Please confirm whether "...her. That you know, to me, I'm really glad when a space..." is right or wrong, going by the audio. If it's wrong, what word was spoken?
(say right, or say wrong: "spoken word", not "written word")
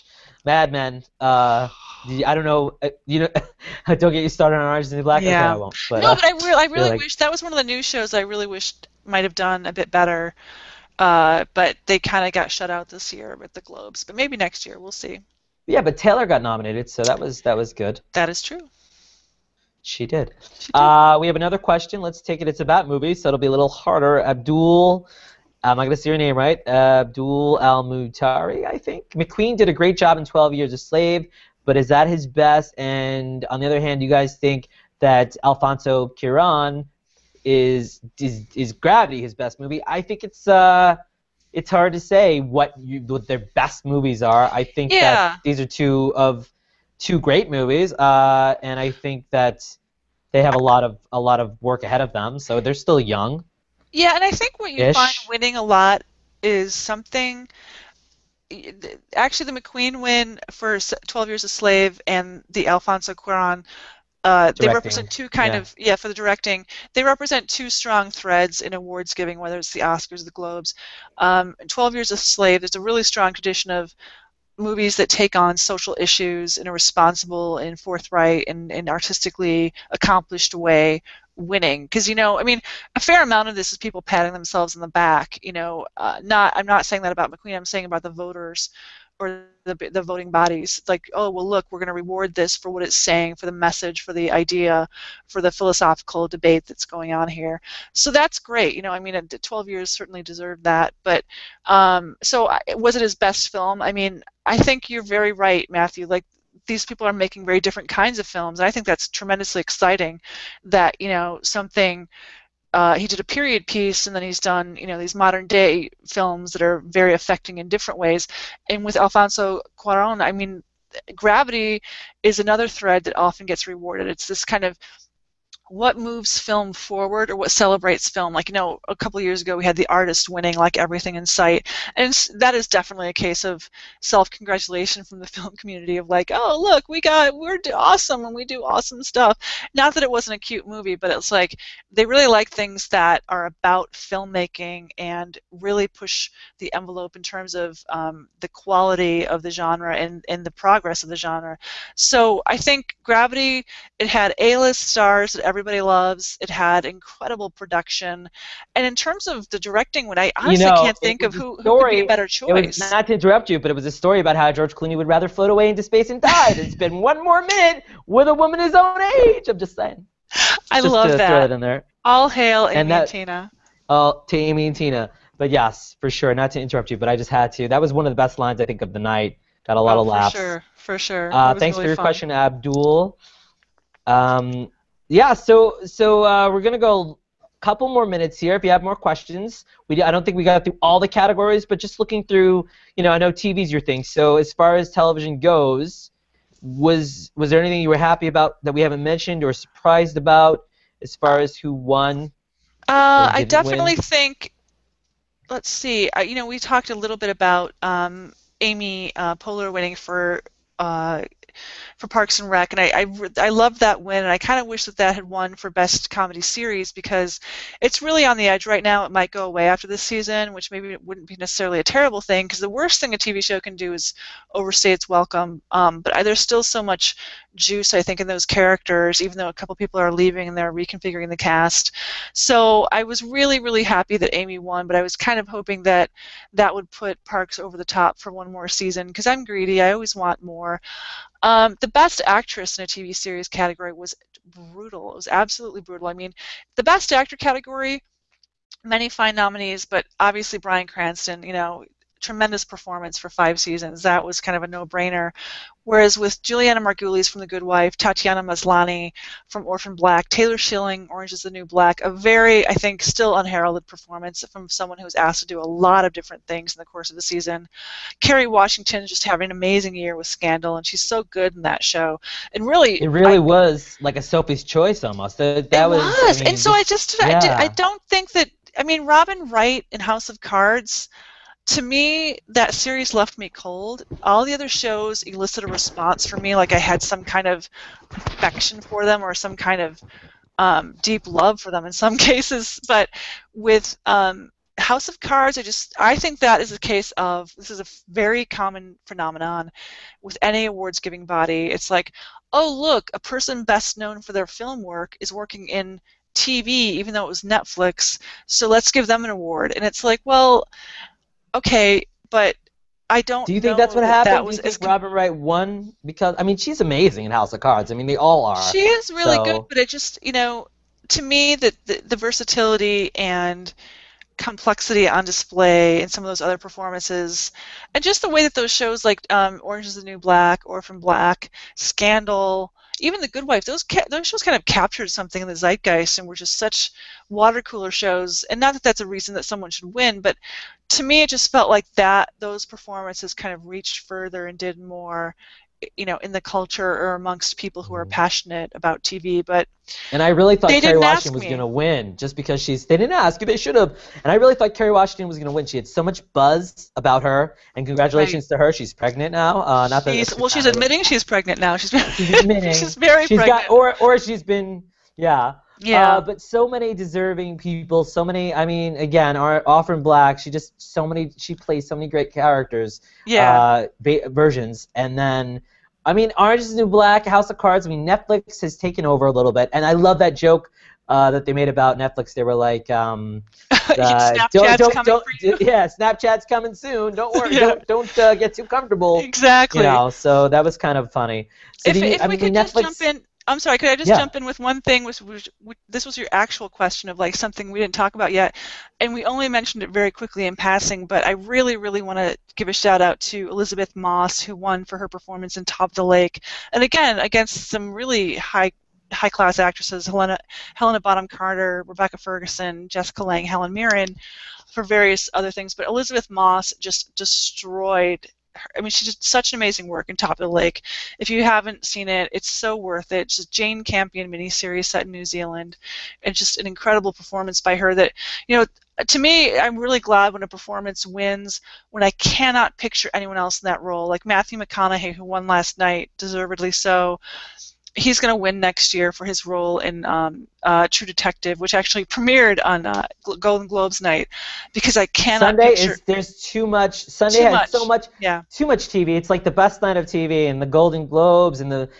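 wrong: "performance", not "space".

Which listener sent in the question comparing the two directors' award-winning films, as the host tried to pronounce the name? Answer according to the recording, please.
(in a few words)
Abdul Al Mutari.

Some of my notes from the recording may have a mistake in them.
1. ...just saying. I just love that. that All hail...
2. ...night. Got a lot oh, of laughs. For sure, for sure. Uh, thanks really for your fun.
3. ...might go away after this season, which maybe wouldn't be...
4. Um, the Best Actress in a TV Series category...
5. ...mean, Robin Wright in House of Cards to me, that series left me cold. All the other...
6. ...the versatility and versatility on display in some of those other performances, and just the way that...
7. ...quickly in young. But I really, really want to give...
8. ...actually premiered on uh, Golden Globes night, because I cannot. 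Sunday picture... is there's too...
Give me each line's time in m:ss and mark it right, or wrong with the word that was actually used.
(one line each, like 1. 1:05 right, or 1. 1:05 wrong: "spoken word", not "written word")
1. 2:49 right
2. 2:58 right
3. 3:39 right
4. 4:01 right
5. 4:38 right
6. 5:22 wrong: "complexity", not "versatility"
7. 6:40 wrong: "passing", not "young"
8. 7:21 right.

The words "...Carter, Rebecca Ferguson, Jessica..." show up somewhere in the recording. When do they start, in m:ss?
6:51.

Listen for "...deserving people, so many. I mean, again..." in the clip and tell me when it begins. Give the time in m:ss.
6:06.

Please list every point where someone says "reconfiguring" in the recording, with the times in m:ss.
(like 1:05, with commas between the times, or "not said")
3:50.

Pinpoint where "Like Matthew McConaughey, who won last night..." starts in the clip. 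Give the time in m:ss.
7:14.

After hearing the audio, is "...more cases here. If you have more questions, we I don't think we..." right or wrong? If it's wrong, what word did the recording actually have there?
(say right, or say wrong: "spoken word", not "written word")
wrong: "minutes", not "cases".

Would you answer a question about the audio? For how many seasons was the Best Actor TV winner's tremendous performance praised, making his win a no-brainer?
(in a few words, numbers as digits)
5.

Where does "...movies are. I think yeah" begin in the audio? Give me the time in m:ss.
0:43.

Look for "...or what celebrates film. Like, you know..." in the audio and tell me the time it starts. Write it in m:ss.
2:07.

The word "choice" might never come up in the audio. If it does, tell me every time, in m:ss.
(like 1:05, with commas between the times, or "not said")
2:42, 4:34.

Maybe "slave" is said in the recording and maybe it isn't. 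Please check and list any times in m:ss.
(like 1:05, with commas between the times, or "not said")
0:30, 1:01, 1:12.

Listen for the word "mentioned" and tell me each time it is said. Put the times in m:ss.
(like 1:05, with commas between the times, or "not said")
3:19, 6:39.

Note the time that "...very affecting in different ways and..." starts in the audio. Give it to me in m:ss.
1:56.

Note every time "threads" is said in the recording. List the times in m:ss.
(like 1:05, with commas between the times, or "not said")
1:08, 2:02.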